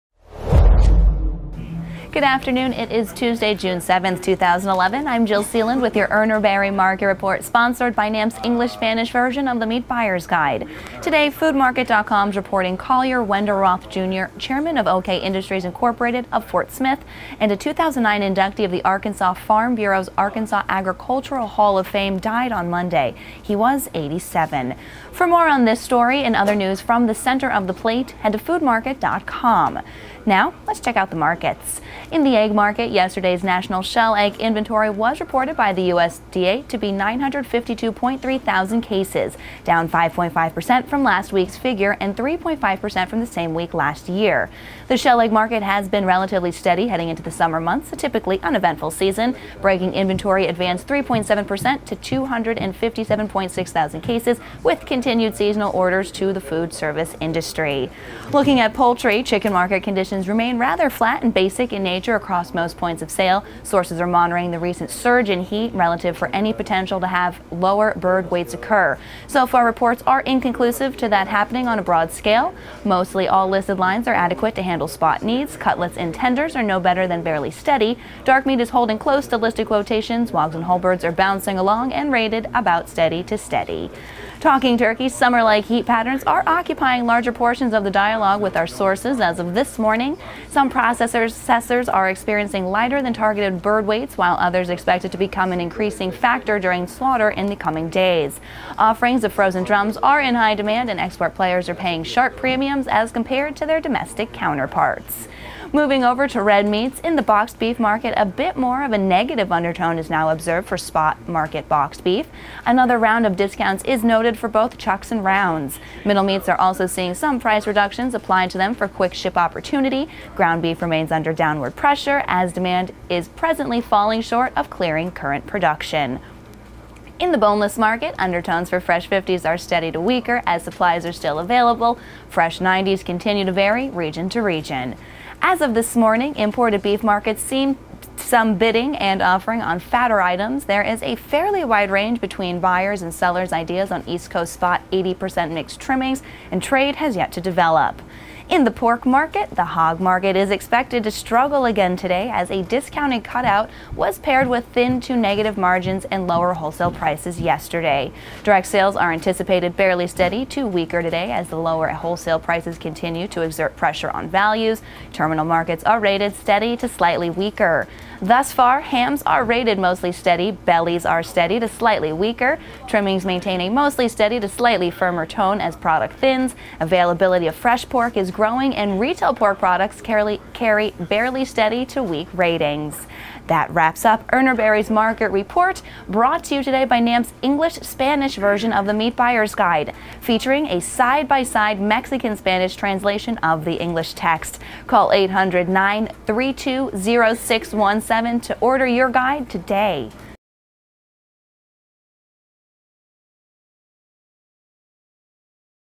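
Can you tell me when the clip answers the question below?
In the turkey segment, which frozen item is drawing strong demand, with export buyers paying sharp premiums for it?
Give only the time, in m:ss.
1:39.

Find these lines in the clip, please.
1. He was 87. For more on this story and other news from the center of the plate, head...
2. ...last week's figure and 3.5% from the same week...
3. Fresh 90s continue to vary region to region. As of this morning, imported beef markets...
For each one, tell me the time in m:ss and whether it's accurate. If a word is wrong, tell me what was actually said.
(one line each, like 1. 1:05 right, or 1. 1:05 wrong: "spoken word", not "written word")
1. 0:23 right
2. 0:41 right
3. 2:12 right.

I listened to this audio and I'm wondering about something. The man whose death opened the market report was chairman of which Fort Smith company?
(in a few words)
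OK Industries Incorporated.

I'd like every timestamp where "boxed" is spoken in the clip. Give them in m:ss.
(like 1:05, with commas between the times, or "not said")
1:47, 1:51.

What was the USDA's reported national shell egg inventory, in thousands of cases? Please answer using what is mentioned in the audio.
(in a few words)
952.3 thousand cases.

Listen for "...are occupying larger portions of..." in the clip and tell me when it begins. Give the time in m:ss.
1:26.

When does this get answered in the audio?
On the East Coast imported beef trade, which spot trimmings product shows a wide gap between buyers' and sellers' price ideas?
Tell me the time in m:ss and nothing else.
2:24.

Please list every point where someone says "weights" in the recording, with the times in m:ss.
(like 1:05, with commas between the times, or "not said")
1:08, 1:33.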